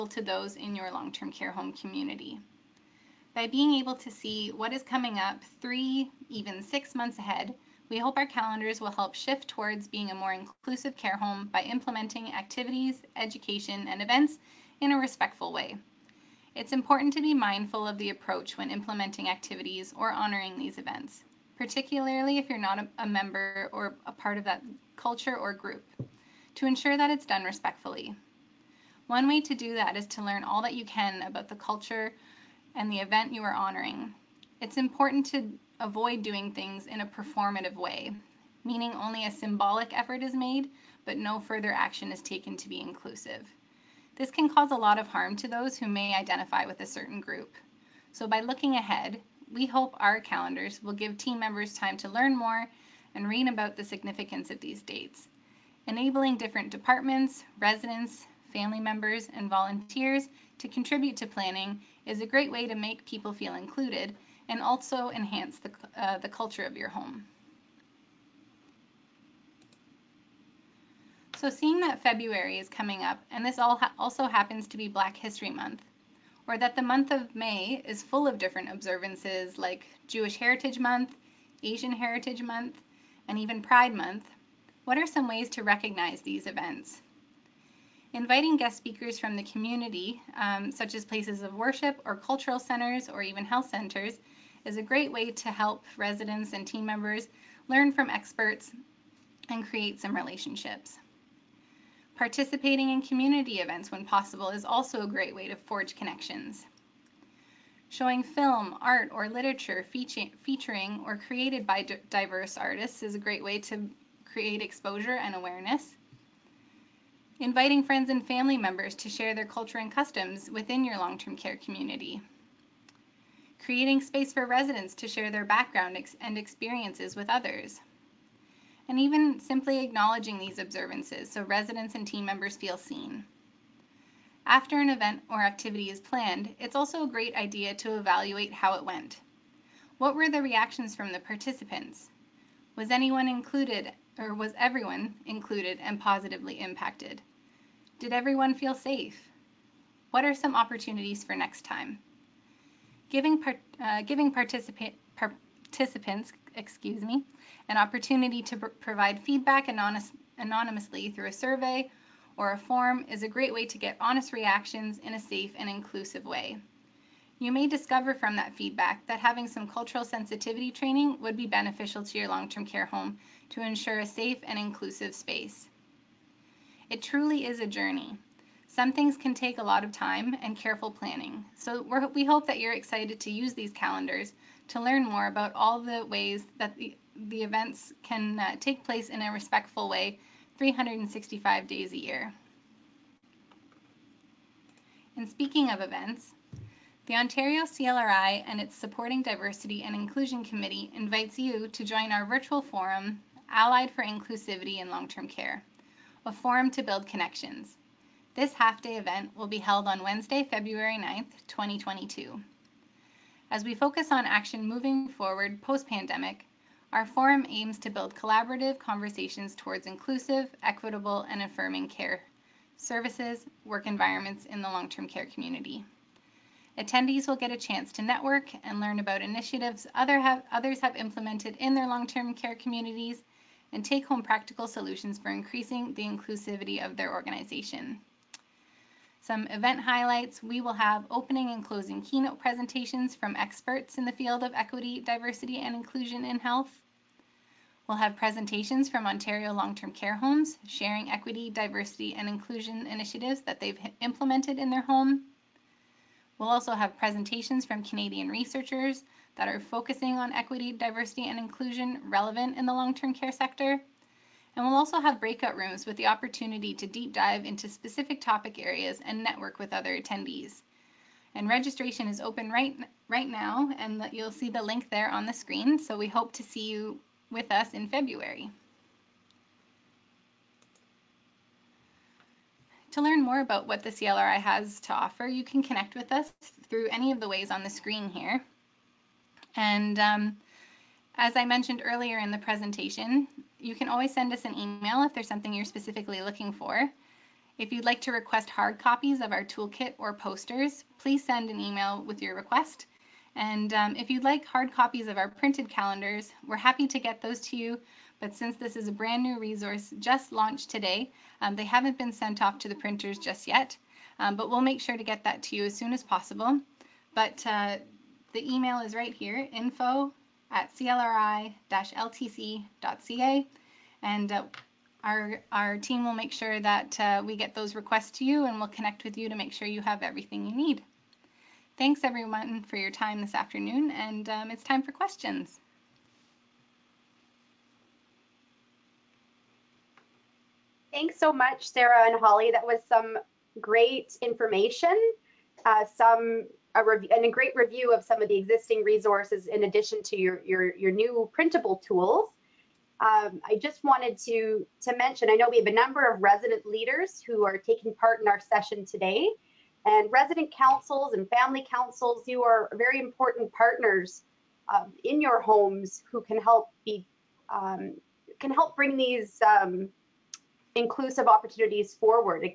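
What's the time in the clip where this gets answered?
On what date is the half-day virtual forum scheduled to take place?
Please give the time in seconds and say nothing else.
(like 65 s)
210 s.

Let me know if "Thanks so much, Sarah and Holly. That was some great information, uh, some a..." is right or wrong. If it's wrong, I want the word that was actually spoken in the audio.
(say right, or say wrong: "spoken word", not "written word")
right.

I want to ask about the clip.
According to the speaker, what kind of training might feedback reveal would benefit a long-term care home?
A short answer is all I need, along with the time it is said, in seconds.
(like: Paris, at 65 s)
Cultural sensitivity training, at 169 s.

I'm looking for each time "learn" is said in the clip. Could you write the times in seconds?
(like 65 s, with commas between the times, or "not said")
30 s, 52 s, 97 s, 184 s, 228 s, 283 s.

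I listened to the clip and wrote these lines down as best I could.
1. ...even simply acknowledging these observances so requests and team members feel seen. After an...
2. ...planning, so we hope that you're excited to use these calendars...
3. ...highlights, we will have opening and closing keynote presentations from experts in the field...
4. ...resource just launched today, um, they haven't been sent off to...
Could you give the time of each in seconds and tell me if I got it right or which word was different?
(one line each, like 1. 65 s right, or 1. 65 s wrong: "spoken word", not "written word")
1. 128 s wrong: "residents", not "requests"
2. 180 s right
3. 239 s right
4. 309 s right.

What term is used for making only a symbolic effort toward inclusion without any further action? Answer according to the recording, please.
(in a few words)
Performative.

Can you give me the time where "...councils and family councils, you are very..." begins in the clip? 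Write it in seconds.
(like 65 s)
360 s.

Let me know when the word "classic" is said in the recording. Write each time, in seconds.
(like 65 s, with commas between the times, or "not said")
not said.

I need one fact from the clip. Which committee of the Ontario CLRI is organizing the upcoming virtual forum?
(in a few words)
Supporting Diversity and Inclusion Committee.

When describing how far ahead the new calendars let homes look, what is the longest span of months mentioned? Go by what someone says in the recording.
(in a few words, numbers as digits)
6 months.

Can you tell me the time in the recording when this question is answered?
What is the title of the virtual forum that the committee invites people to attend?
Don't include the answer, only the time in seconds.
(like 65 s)
203 s.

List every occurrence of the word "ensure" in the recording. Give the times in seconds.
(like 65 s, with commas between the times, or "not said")
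26 s, 173 s.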